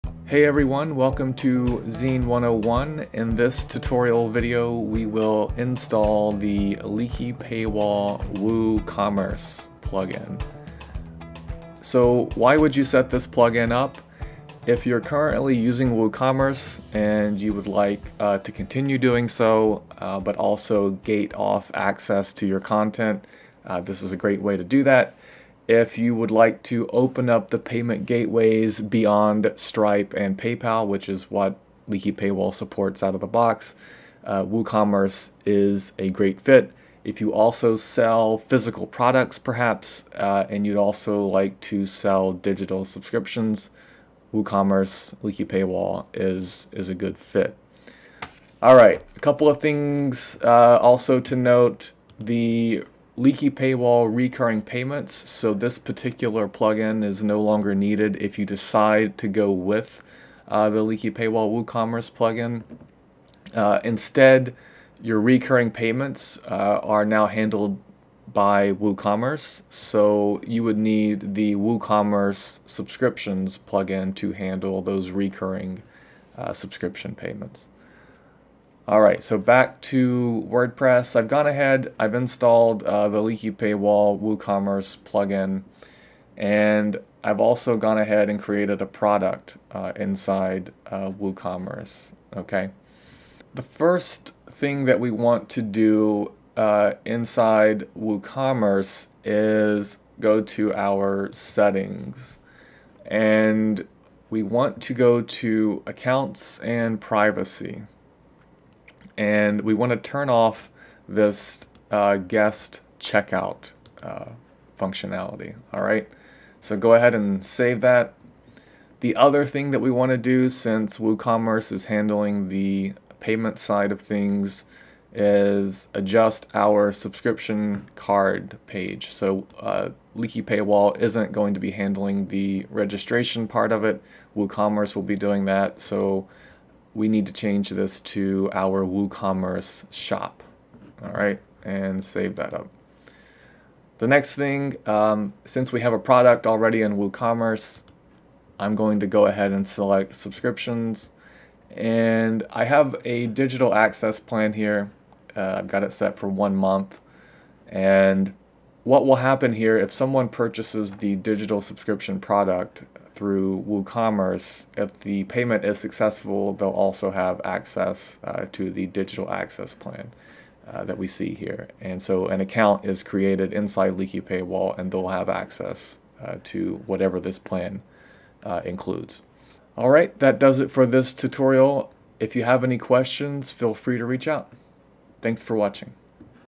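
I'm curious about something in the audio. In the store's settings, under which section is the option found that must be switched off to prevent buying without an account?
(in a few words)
Accounts and privacy.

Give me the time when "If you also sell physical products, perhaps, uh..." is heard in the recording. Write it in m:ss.
0:37.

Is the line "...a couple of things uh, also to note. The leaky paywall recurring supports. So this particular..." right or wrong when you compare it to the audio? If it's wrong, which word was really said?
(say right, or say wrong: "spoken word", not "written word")
wrong: "payments", not "supports".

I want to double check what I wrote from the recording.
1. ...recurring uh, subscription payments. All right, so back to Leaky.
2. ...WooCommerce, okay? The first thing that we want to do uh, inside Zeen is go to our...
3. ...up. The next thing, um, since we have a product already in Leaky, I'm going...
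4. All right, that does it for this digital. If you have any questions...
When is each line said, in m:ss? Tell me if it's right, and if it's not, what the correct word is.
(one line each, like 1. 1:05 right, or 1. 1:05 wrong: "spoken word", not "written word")
1. 1:15 wrong: "WordPress", not "Leaky"
2. 1:31 wrong: "WooCommerce", not "Zeen"
3. 2:22 wrong: "WooCommerce", not "Leaky"
4. 2:59 wrong: "tutorial", not "digital".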